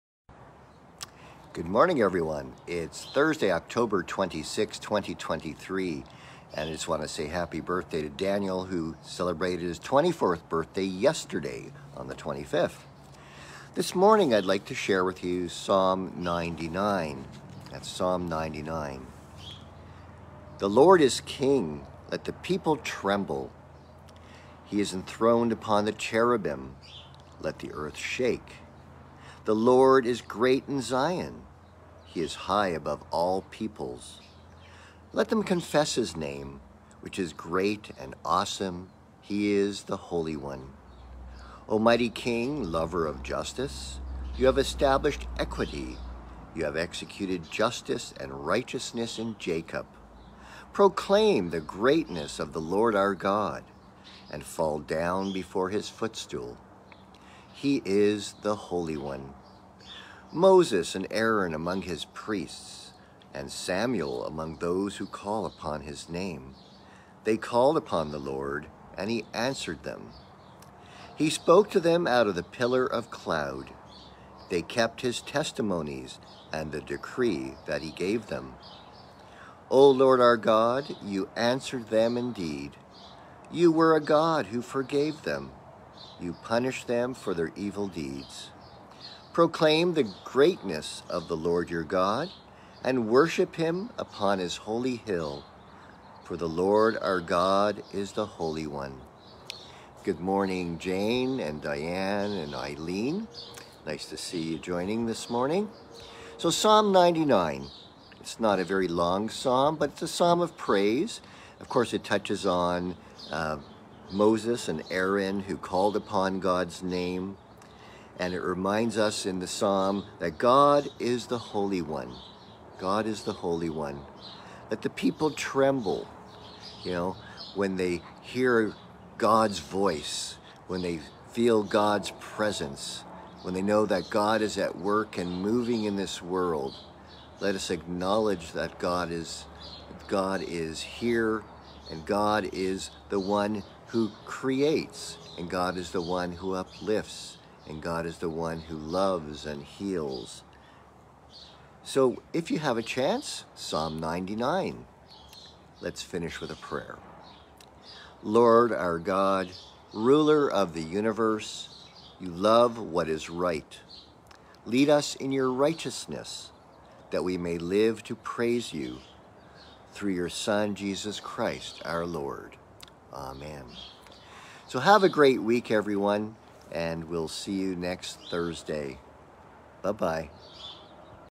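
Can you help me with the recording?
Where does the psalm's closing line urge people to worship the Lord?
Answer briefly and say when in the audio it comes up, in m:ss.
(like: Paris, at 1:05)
upon his holy hill, at 1:34.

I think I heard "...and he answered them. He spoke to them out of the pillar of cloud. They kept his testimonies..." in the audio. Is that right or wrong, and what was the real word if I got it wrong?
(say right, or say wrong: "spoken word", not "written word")
right.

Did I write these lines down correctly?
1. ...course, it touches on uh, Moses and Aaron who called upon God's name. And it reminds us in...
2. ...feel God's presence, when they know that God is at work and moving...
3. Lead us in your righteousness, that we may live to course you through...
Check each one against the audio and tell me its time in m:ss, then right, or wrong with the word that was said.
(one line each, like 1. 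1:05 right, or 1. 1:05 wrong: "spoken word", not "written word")
1. 1:51 right
2. 2:11 right
3. 2:44 wrong: "praise", not "course".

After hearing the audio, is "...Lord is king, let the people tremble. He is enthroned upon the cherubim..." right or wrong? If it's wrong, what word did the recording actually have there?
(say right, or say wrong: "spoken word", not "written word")
right.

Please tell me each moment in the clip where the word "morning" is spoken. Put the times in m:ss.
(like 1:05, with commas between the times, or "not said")
0:01, 0:13, 1:40, 1:45.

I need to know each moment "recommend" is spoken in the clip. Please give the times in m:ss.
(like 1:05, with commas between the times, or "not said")
not said.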